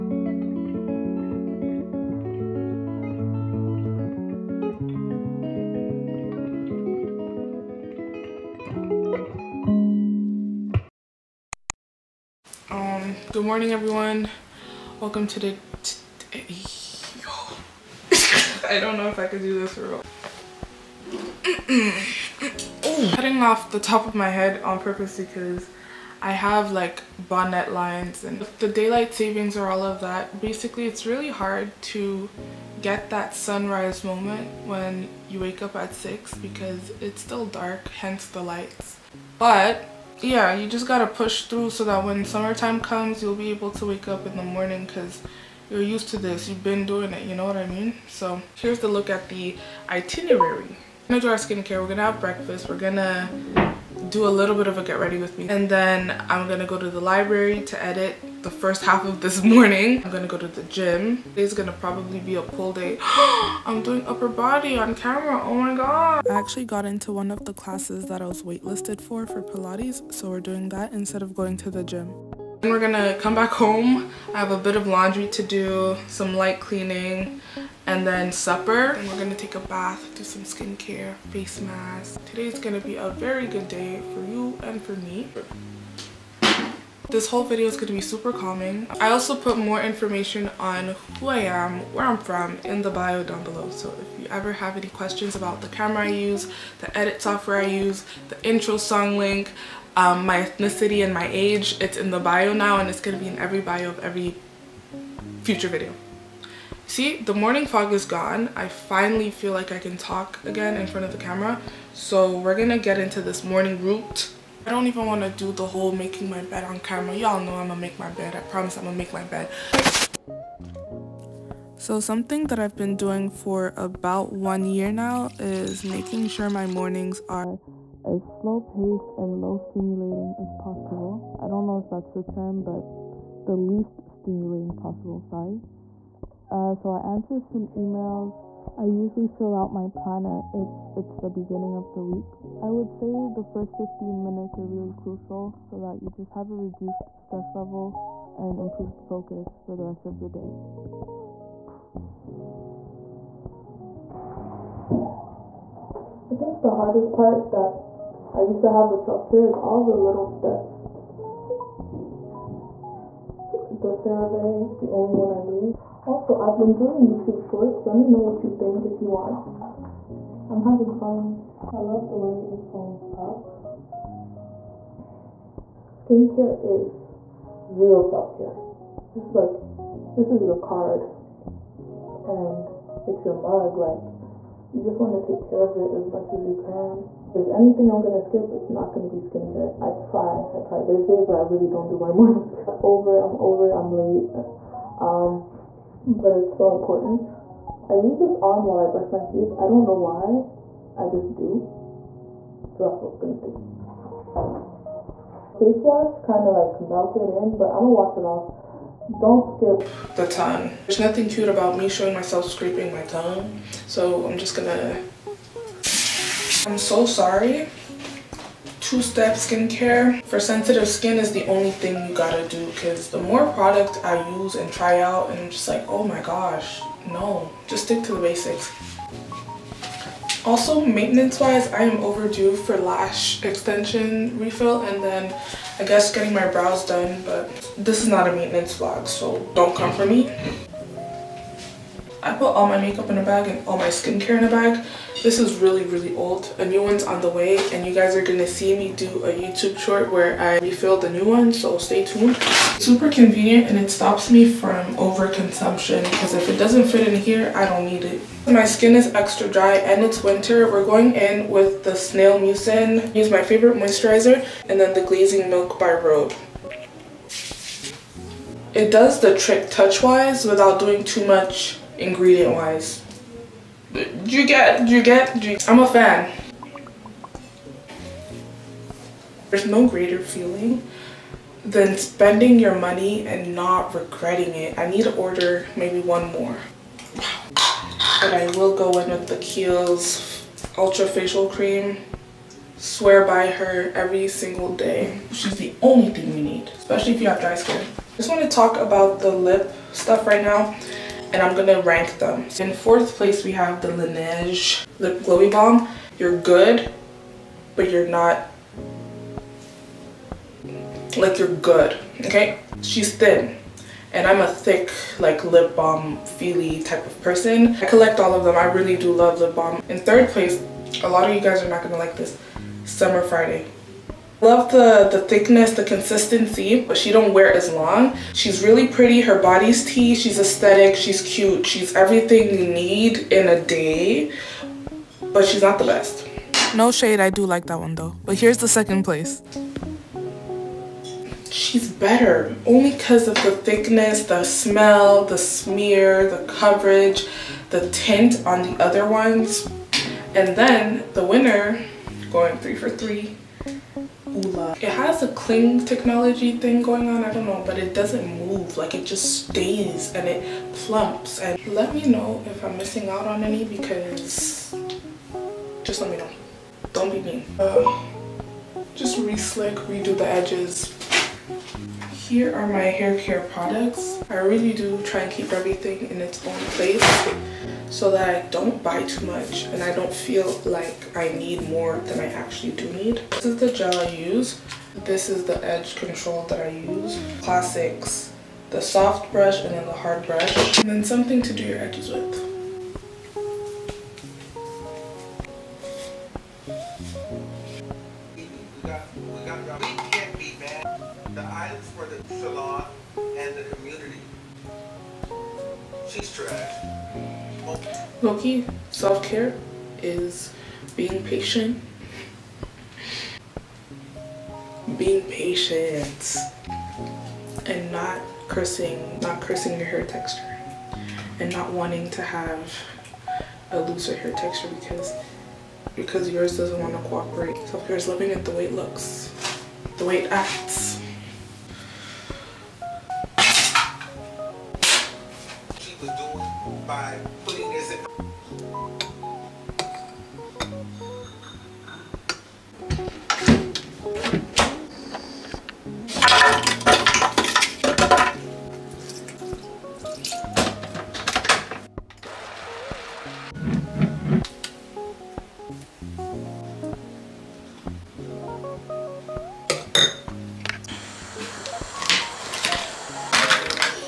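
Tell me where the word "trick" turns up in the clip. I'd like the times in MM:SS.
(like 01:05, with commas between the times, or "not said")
04:29.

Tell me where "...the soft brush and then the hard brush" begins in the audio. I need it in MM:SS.
06:28.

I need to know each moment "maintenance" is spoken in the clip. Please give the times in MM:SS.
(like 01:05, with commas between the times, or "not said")
03:50, 03:58.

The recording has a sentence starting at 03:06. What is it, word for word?
If there's anything I'm going to skip, it's not going to be skincare.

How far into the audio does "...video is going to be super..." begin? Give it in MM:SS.
01:27.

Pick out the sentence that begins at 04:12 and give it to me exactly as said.
Super convenient and it stops me from overconsumption because if it doesn't fit in here, I don't need it.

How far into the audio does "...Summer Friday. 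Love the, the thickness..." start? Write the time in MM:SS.
05:22.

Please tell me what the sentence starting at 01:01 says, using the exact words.
Today's gonna probably be a pull day.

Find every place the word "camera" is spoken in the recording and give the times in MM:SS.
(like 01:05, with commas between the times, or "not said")
01:04, 01:35, 01:51, 01:56.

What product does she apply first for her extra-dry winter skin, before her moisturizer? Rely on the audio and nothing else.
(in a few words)
Snail Mucin.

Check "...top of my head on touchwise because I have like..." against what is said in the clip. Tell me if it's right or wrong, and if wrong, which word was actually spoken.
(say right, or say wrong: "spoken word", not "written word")
wrong: "purpose", not "touchwise".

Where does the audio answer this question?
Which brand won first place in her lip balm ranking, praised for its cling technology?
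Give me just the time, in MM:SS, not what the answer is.
05:54.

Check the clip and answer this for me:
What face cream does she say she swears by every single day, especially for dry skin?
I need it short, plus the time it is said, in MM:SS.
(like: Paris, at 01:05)
Kiehl's Ultra Facial Cream, at 04:49.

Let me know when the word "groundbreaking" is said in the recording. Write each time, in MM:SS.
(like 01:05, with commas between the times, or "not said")
not said.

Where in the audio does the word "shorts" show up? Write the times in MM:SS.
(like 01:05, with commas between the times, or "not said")
02:47, 04:09.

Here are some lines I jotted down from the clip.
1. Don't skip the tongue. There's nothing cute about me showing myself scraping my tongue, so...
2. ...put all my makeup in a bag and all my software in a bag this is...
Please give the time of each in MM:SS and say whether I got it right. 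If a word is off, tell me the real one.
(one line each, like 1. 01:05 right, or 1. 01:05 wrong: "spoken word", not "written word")
1. 03:29 right
2. 04:02 wrong: "skincare", not "software".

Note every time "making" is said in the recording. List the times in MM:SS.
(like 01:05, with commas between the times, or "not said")
01:55, 02:05.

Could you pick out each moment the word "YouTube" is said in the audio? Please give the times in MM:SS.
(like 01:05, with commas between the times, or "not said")
02:47, 04:09.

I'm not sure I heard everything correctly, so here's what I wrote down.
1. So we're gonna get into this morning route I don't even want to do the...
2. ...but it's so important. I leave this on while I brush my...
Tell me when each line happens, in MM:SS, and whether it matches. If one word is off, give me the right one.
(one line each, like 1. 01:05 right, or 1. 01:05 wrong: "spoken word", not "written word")
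1. 01:51 right
2. 03:16 right.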